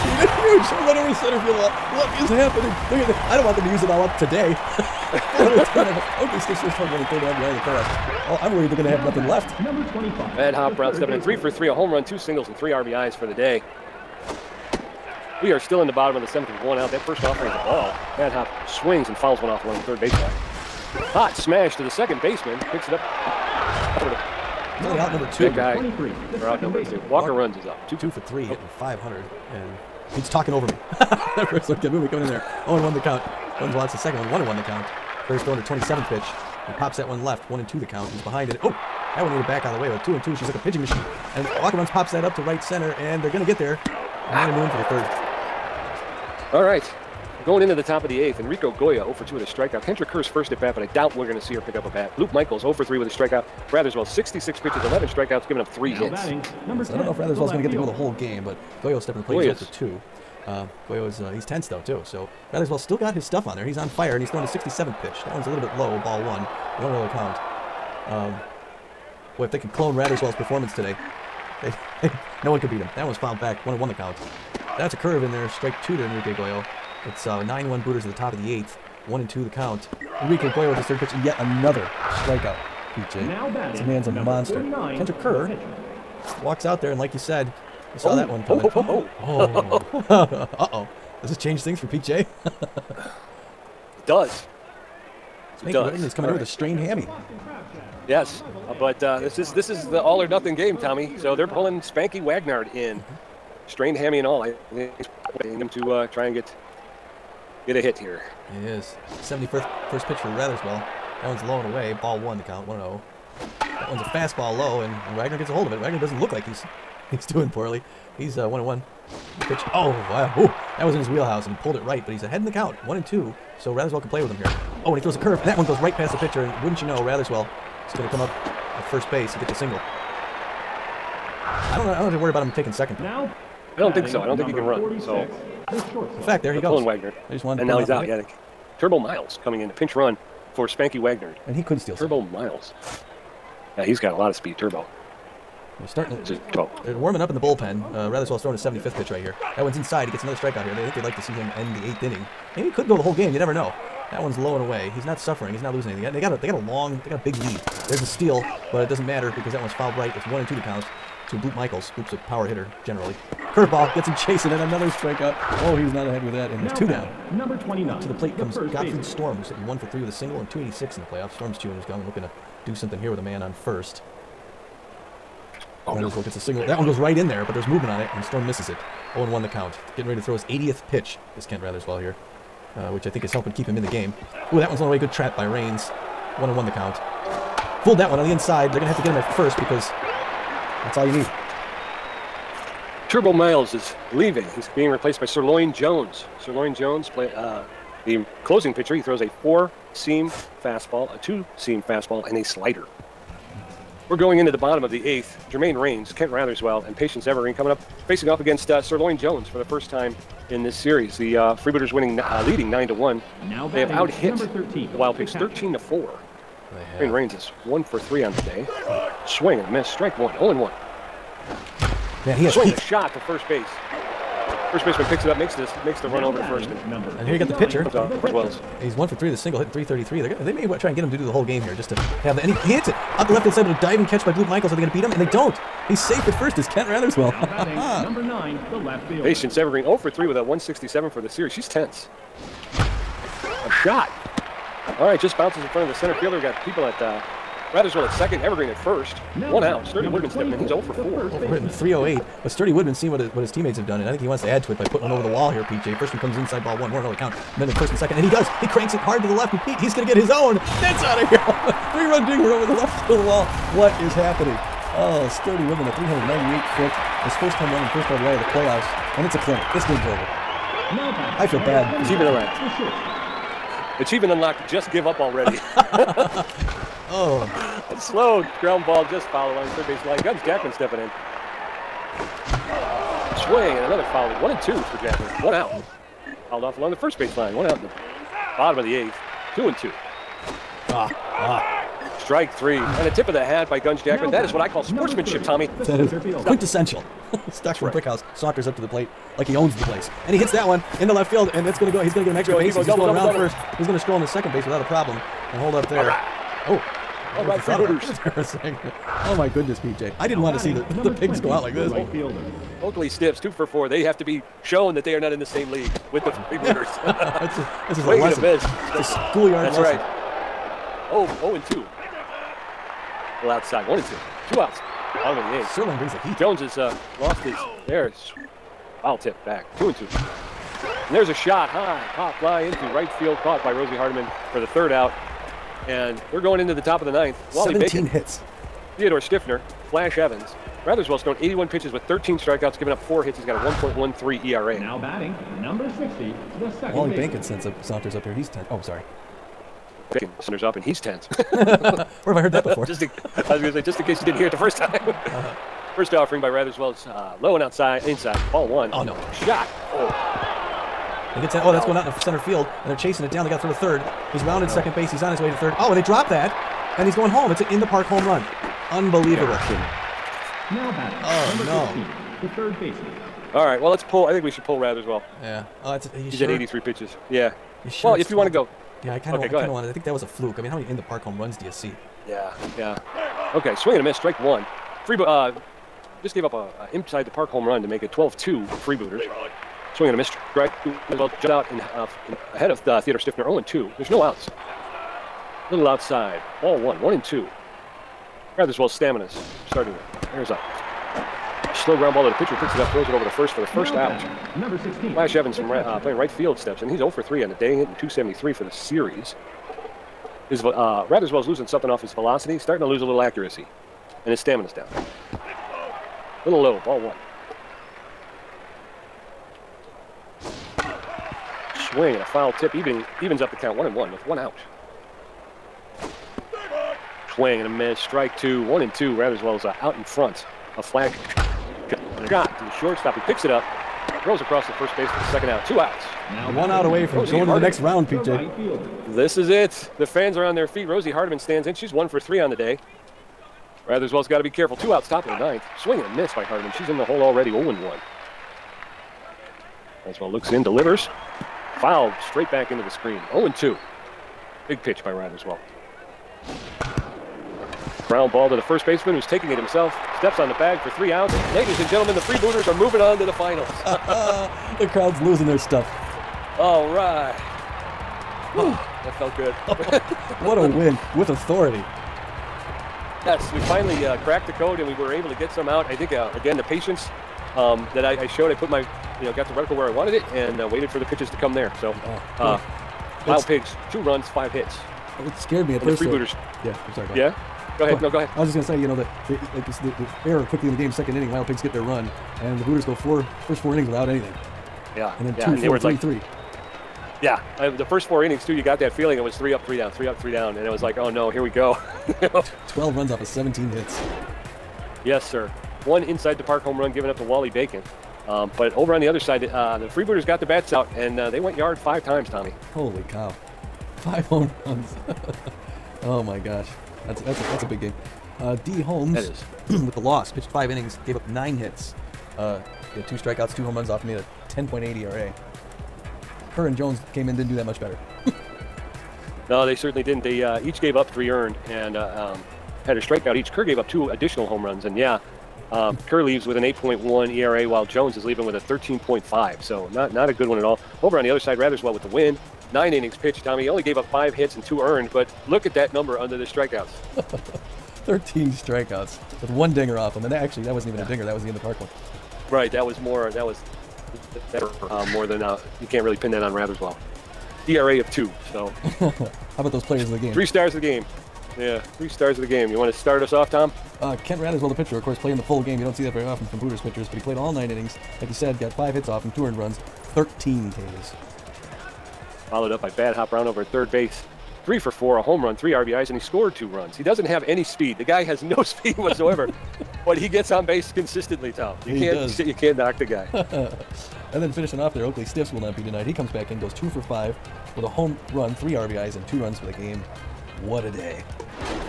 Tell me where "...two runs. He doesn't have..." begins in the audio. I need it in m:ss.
9:36.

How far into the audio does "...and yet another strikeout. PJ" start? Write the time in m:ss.
1:21.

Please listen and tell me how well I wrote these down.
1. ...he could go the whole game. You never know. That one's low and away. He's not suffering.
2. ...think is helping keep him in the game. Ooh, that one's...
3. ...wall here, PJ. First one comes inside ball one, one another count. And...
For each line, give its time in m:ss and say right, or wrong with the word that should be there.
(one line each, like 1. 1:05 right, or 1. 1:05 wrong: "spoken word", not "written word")
1. 2:32 right
2. 3:03 right
3. 4:15 right.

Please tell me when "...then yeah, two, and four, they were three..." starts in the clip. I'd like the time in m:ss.
8:15.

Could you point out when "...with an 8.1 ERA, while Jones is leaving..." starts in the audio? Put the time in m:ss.
8:56.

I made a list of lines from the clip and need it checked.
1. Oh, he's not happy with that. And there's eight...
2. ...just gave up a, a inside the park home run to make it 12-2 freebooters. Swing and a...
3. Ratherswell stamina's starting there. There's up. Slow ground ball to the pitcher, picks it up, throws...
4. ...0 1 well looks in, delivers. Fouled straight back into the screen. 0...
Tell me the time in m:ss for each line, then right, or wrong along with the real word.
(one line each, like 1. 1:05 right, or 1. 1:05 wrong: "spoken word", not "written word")
1. 2:45 wrong: "two", not "eight"
2. 6:26 right
3. 6:38 right
4. 7:27 right.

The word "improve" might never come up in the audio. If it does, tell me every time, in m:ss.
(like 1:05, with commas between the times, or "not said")
not said.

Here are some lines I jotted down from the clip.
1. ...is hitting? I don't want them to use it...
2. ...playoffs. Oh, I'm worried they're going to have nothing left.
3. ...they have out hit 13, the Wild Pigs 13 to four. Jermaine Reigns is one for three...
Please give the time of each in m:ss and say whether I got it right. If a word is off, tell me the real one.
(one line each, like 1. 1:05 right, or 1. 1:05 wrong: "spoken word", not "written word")
1. 0:02 wrong: "happening", not "hitting"
2. 0:07 right
3. 3:33 right.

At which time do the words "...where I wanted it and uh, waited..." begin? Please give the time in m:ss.
7:59.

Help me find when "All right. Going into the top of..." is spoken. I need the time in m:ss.
0:46.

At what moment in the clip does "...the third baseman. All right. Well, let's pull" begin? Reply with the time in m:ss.
6:12.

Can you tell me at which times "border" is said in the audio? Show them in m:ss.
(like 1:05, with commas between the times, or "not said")
not said.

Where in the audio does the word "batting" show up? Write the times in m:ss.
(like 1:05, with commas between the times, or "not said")
0:56, 5:44, 6:10.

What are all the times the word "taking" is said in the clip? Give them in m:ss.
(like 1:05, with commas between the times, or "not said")
2:12, 7:39.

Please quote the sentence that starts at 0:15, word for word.
We are still in the bottom of the seventh with one out.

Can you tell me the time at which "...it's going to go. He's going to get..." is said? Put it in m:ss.
5:01.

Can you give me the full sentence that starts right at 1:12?
That one was fouled back, one and one the count.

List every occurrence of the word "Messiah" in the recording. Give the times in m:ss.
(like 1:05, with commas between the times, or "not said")
not said.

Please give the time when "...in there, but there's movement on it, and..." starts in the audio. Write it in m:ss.
2:57.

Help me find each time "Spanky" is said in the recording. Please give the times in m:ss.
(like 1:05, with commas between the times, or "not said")
1:35, 1:41, 2:20.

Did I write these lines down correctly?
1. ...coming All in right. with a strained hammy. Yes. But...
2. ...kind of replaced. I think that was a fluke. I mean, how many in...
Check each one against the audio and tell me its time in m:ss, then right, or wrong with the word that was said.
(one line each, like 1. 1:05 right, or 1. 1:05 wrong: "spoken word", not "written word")
1. 1:36 right
2. 6:19 wrong: "wanted", not "replaced".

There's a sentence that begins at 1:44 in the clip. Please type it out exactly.
I think him to uh, try and get get a hit here.